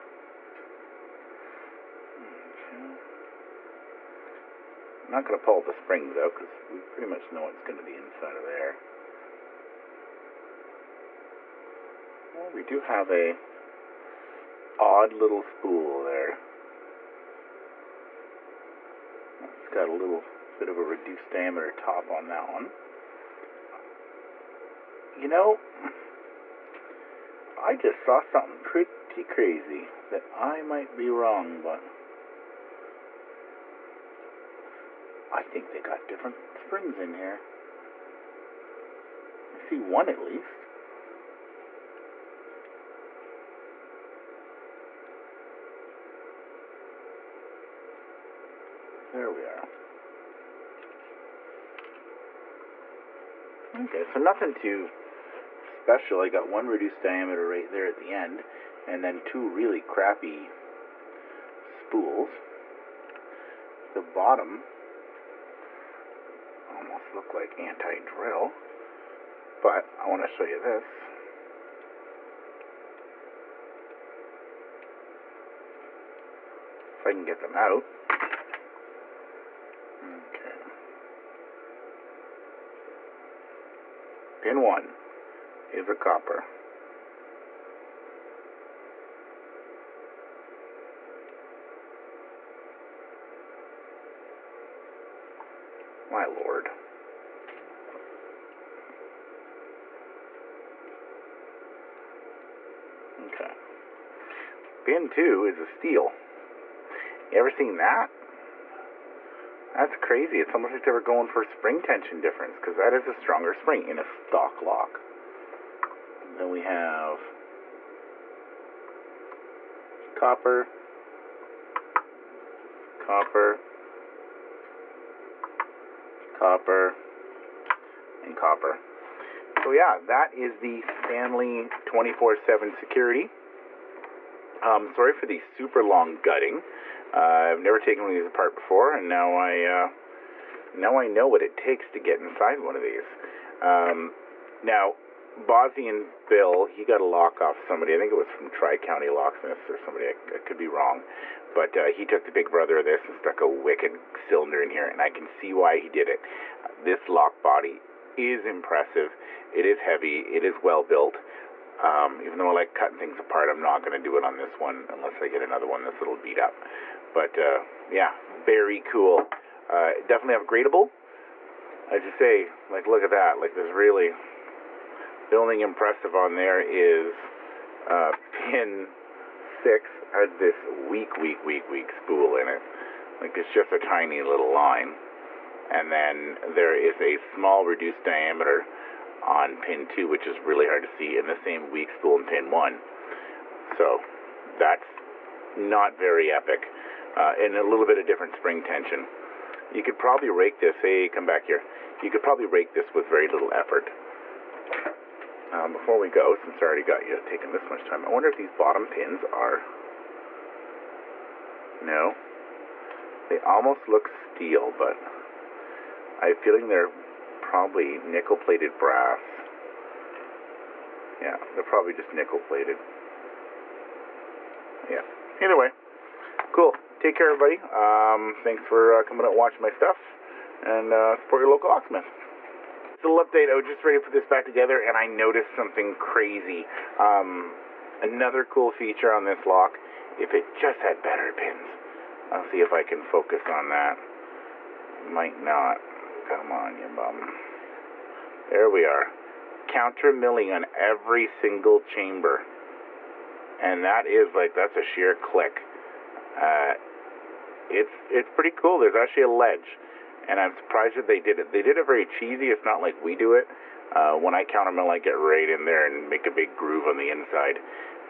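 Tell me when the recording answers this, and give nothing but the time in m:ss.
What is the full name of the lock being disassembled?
2:10.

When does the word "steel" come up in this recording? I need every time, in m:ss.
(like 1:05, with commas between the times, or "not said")
1:45, 3:34.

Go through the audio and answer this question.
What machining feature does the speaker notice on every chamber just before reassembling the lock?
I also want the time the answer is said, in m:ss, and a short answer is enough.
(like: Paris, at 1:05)
Counter milling, at 4:09.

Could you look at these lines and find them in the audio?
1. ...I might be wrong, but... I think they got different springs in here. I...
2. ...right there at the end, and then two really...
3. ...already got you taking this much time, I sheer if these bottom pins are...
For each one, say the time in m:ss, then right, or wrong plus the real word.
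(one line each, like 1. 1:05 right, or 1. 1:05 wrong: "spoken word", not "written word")
1. 0:30 right
2. 0:57 right
3. 3:26 wrong: "wonder", not "sheer".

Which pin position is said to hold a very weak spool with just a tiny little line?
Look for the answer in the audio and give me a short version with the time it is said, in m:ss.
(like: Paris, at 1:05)
Pin 6, at 2:58.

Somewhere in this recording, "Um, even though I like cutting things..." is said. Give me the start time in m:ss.
2:41.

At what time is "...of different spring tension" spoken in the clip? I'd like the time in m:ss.
3:17.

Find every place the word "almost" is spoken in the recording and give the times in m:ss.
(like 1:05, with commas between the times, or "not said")
1:06, 1:50, 3:33.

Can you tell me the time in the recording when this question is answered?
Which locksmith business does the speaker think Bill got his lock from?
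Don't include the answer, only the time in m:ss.
2:28.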